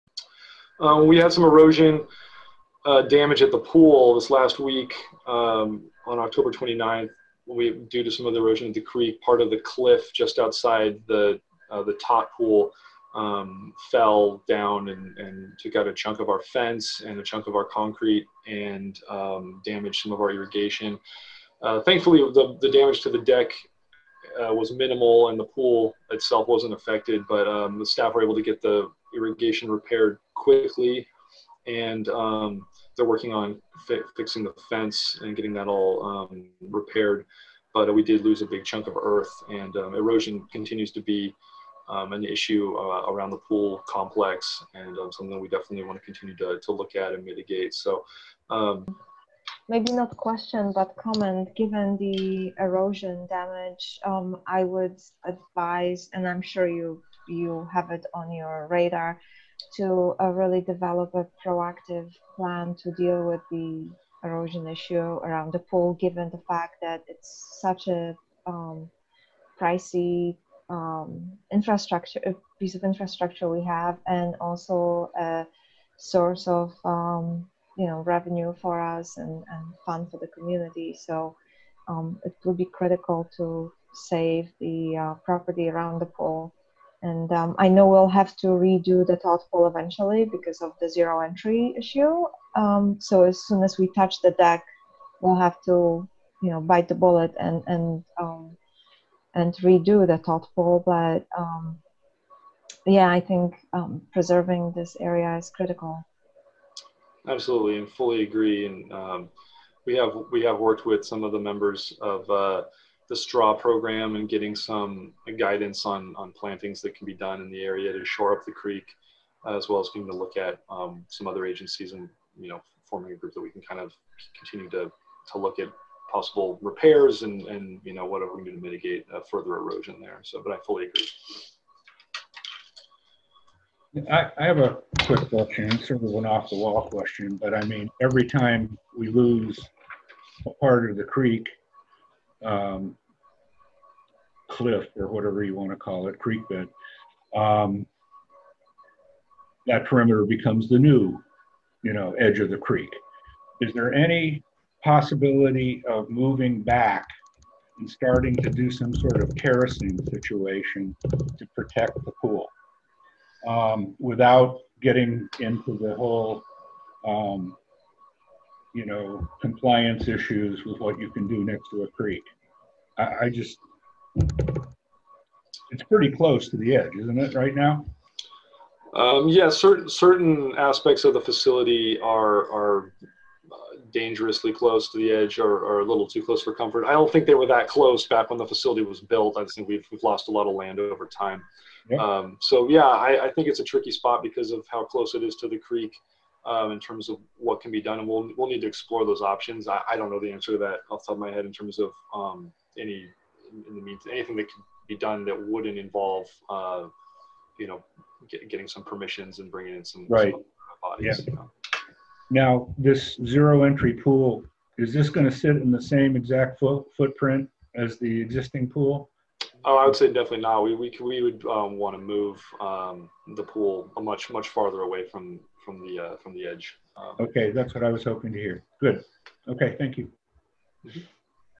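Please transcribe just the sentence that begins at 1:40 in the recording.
But um, yeah, I think um, preserving this area is critical.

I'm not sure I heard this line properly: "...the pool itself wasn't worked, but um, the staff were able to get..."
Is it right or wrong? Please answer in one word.
wrong.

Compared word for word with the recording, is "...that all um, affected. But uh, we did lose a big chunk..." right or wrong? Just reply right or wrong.
wrong.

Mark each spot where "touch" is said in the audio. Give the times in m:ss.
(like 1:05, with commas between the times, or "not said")
1:33.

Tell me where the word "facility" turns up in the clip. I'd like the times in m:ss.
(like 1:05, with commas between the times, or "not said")
3:01, 3:08.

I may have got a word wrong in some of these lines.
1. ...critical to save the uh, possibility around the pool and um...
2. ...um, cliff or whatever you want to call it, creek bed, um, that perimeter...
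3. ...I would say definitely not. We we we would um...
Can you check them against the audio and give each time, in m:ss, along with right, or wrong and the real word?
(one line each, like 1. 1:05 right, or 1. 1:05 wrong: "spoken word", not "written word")
1. 1:22 wrong: "property", not "possibility"
2. 2:22 right
3. 3:39 right.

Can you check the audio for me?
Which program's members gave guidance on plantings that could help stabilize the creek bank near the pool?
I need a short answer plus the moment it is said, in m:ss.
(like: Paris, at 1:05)
STRAW, at 1:53.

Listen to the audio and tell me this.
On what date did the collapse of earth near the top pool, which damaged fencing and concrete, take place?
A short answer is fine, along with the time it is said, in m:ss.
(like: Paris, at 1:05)
October 29th, at 0:06.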